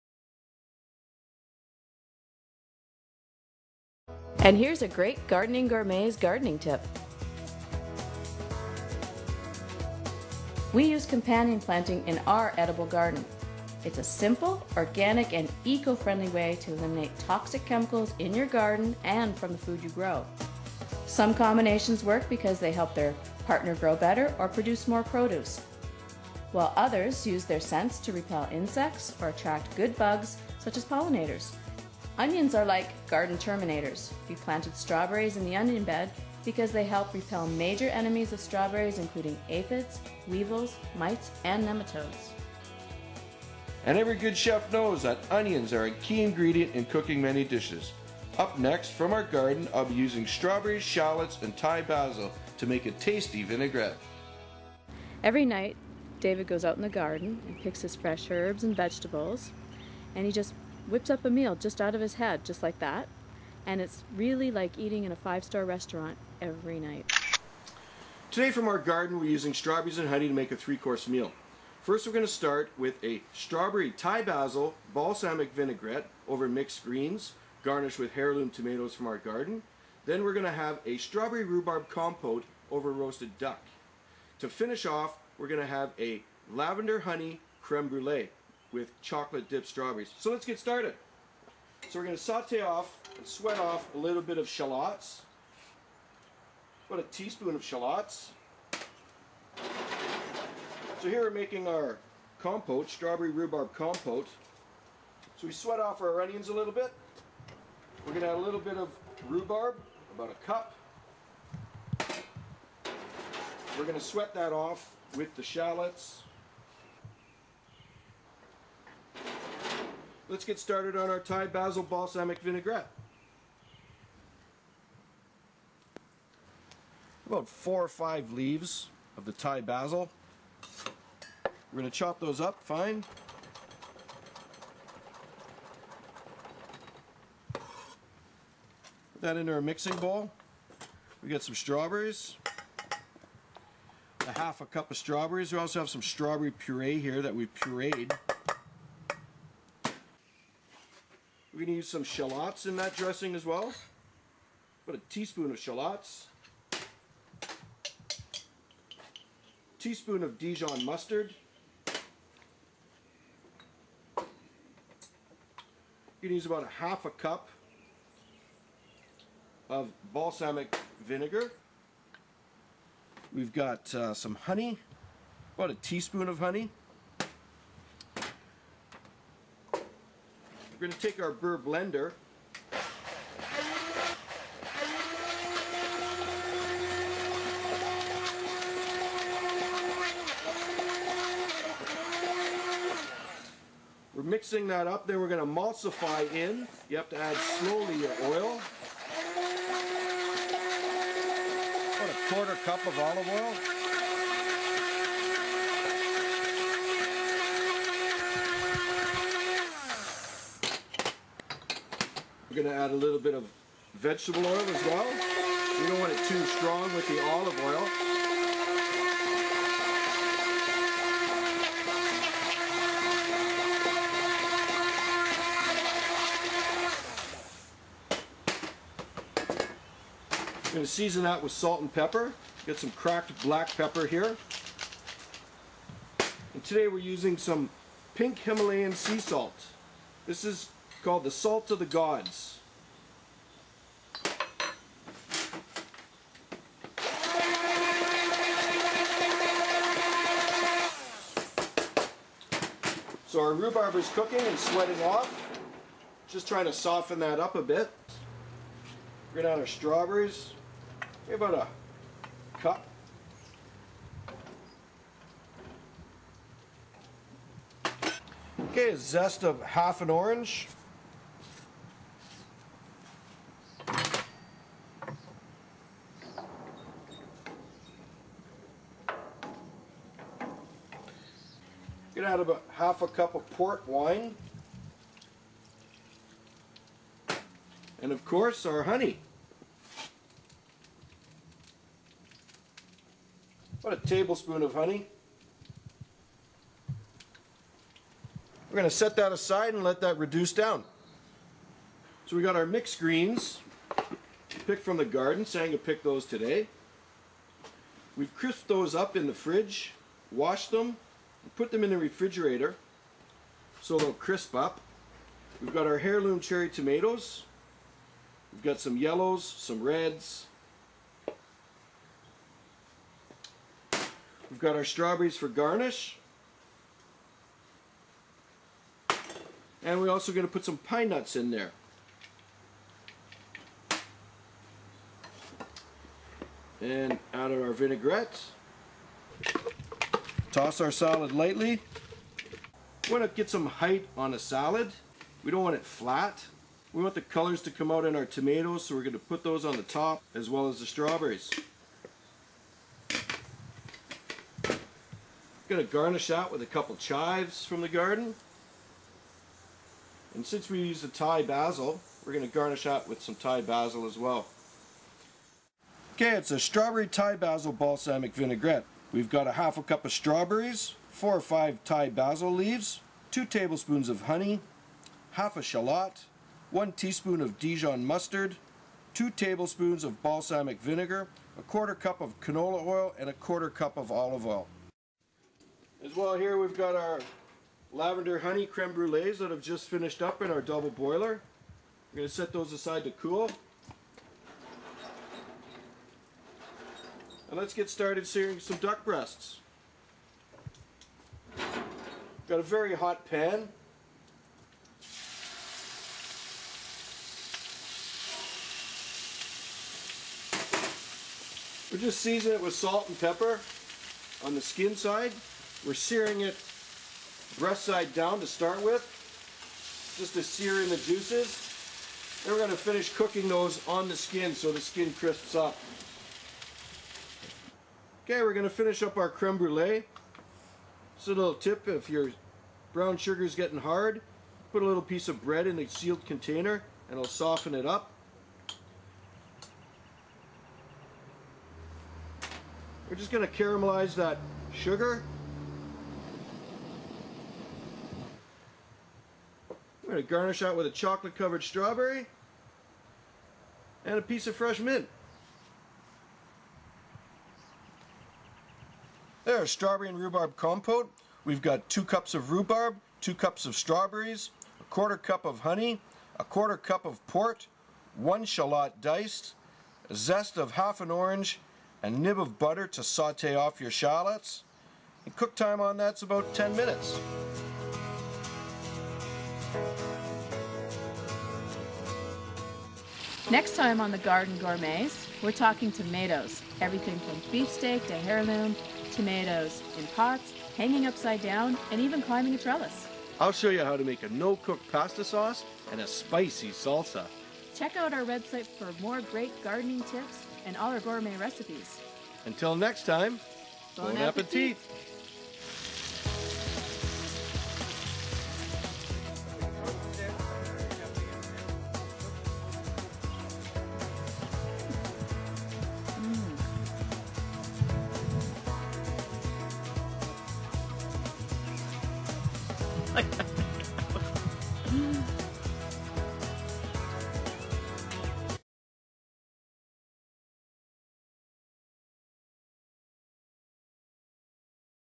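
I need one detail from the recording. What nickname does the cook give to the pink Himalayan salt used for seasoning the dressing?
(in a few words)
The Salt of the Gods.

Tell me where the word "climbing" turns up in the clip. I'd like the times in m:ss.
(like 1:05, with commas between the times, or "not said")
8:12.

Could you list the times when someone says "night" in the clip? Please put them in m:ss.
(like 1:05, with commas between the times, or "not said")
0:55, 1:06.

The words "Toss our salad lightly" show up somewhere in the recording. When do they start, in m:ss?
5:40.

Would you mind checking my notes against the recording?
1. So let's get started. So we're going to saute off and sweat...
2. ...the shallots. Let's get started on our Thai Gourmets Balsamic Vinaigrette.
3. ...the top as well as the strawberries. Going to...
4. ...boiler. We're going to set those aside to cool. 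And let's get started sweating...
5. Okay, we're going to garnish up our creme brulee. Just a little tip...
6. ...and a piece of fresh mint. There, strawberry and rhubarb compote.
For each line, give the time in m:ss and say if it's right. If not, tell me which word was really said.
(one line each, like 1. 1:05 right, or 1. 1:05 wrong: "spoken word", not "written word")
1. 1:30 right
2. 1:55 wrong: "Basil", not "Gourmets"
3. 5:49 right
4. 6:30 wrong: "searing", not "sweating"
5. 7:08 wrong: "finish", not "garnish"
6. 7:34 right.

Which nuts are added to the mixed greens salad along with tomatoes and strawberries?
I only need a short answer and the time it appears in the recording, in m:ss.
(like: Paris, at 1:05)
pine nuts, at 5:30.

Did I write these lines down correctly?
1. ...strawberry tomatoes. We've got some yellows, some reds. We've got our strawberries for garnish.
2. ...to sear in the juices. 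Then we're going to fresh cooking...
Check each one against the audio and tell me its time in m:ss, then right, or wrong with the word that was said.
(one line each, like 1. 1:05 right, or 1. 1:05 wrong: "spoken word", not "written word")
1. 5:16 wrong: "cherry", not "strawberry"
2. 7:00 wrong: "finish", not "fresh".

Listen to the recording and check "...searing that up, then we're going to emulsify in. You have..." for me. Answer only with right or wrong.
wrong.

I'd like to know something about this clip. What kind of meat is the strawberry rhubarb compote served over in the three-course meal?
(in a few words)
roasted duck.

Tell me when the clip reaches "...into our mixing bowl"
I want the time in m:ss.
2:19.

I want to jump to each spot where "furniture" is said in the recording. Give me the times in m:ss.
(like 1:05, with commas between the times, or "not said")
not said.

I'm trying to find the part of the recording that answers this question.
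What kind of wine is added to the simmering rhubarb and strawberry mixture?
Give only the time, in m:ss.
4:43.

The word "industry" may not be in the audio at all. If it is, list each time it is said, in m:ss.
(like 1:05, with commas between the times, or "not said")
not said.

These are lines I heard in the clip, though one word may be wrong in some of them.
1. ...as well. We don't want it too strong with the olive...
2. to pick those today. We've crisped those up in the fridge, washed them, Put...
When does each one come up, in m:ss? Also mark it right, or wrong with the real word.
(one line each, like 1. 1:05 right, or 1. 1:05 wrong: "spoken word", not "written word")
1. 3:34 right
2. 5:05 right.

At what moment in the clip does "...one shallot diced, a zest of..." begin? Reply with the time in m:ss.
7:48.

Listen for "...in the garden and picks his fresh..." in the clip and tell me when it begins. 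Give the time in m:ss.
0:56.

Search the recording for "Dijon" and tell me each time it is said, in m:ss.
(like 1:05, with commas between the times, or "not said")
2:40, 6:17.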